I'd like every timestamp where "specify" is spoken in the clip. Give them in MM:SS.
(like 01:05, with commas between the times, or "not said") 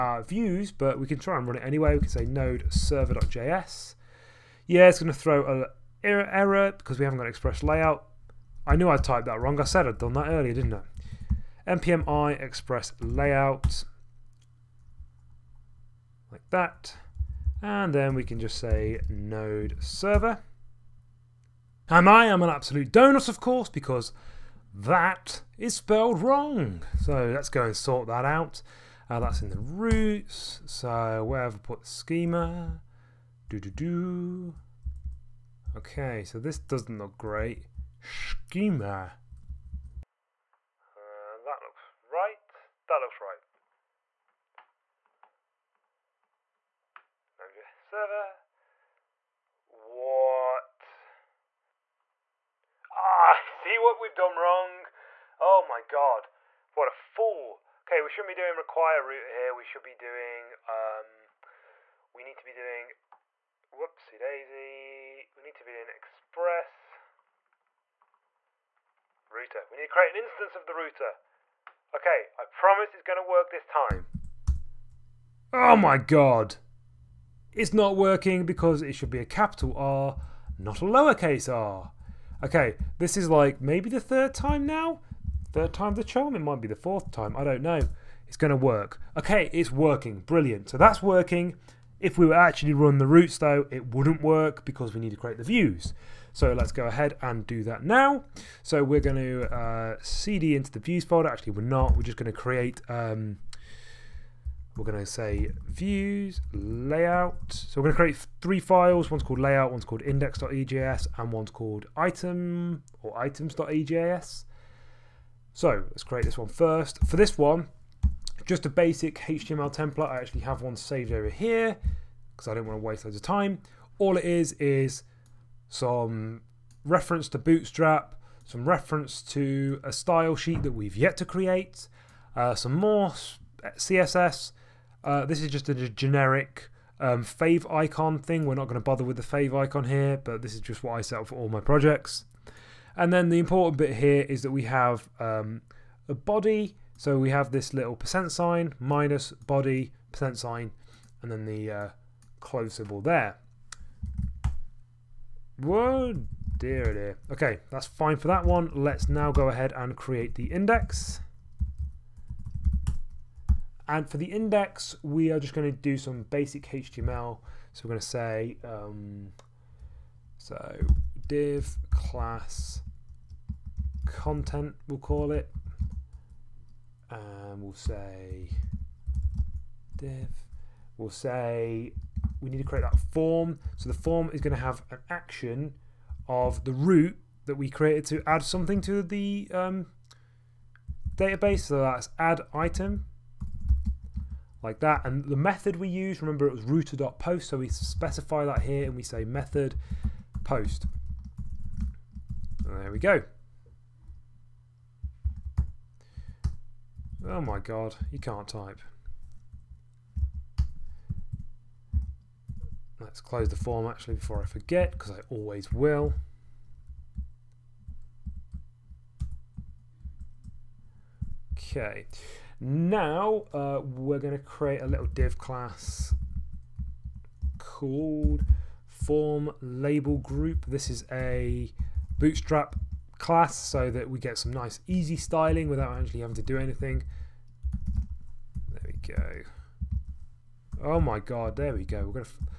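03:17.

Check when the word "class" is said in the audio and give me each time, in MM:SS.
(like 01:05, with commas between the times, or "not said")
02:51, 03:45, 03:53.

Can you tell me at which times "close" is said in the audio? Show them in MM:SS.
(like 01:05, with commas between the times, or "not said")
02:32, 03:33.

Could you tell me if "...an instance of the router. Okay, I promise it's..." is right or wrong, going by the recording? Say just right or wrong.
right.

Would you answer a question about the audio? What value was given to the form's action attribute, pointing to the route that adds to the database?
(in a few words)
add item.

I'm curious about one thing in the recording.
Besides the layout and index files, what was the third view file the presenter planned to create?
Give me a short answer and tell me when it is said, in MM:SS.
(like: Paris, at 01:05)
items.ejs, at 01:53.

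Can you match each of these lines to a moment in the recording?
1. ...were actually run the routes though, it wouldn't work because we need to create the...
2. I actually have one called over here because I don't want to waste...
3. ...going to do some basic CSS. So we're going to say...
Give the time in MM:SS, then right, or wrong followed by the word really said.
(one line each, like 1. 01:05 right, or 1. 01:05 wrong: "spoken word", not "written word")
1. 01:32 right
2. 02:00 wrong: "saved", not "called"
3. 02:45 wrong: "HTML", not "CSS".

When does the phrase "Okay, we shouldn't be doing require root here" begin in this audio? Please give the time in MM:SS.
00:57.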